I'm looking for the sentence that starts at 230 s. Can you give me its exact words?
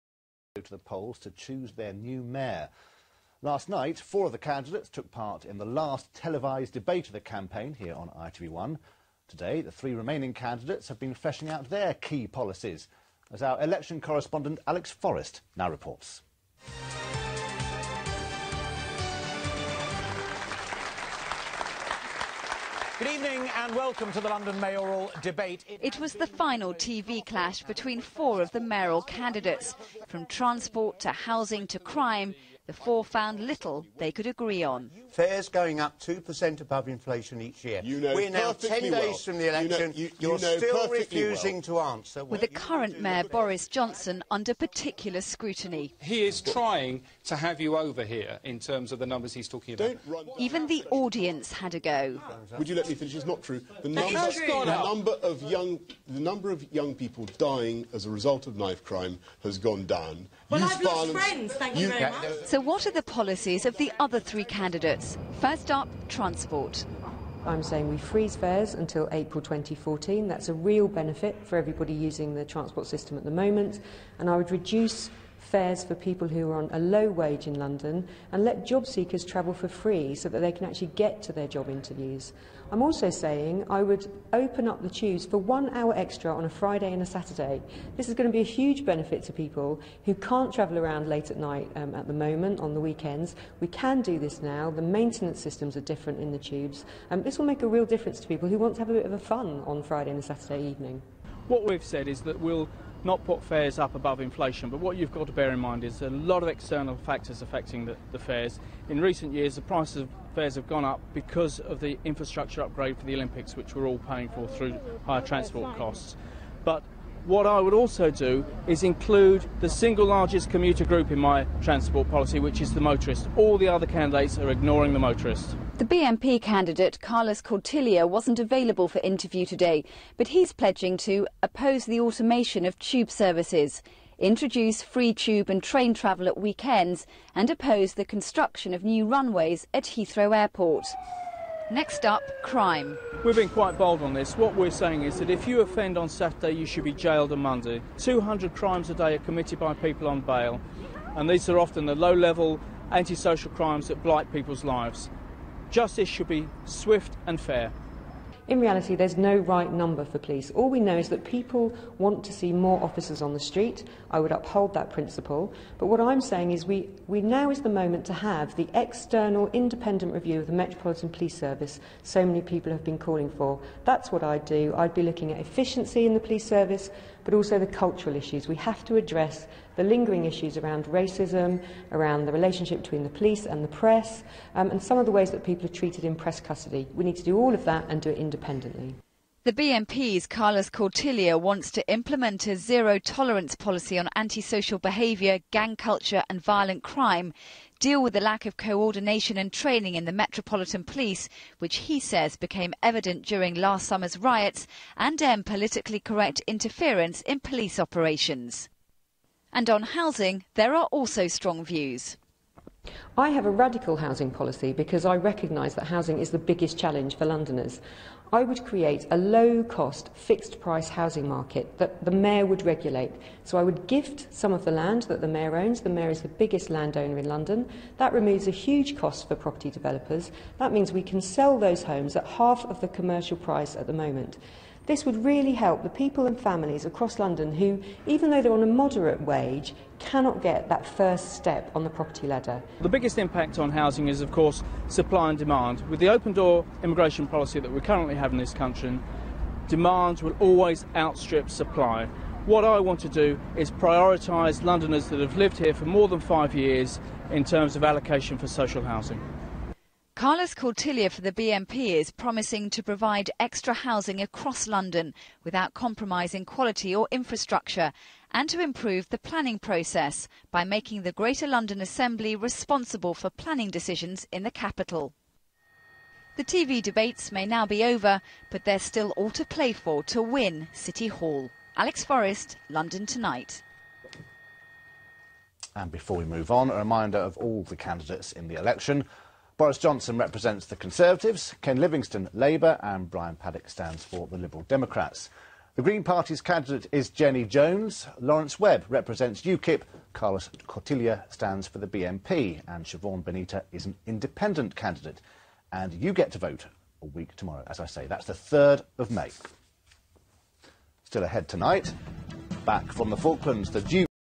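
That means we can sell those homes at half of the commercial price at the moment.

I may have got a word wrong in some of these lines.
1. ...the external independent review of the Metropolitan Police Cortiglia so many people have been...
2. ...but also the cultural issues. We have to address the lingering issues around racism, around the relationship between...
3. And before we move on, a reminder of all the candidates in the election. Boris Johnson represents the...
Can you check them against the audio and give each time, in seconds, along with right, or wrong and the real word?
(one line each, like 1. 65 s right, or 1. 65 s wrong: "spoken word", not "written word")
1. 168 s wrong: "Service", not "Cortiglia"
2. 177 s right
3. 285 s right.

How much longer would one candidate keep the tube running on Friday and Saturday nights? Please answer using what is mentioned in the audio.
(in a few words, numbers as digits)
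1 hour.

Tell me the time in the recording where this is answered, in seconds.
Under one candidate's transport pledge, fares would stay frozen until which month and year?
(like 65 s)
69 s.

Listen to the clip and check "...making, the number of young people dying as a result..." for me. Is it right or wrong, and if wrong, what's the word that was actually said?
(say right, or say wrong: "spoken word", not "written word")
wrong: "young", not "making".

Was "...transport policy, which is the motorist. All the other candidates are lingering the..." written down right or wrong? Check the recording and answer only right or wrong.
wrong.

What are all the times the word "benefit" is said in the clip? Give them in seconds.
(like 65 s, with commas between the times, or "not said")
70 s, 88 s.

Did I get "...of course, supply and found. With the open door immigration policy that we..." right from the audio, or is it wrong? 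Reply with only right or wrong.
wrong.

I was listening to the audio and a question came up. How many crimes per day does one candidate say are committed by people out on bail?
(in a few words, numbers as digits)
200.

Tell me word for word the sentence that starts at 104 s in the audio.
But what you've got to bear in mind is a lot of external factors affecting the, the fares.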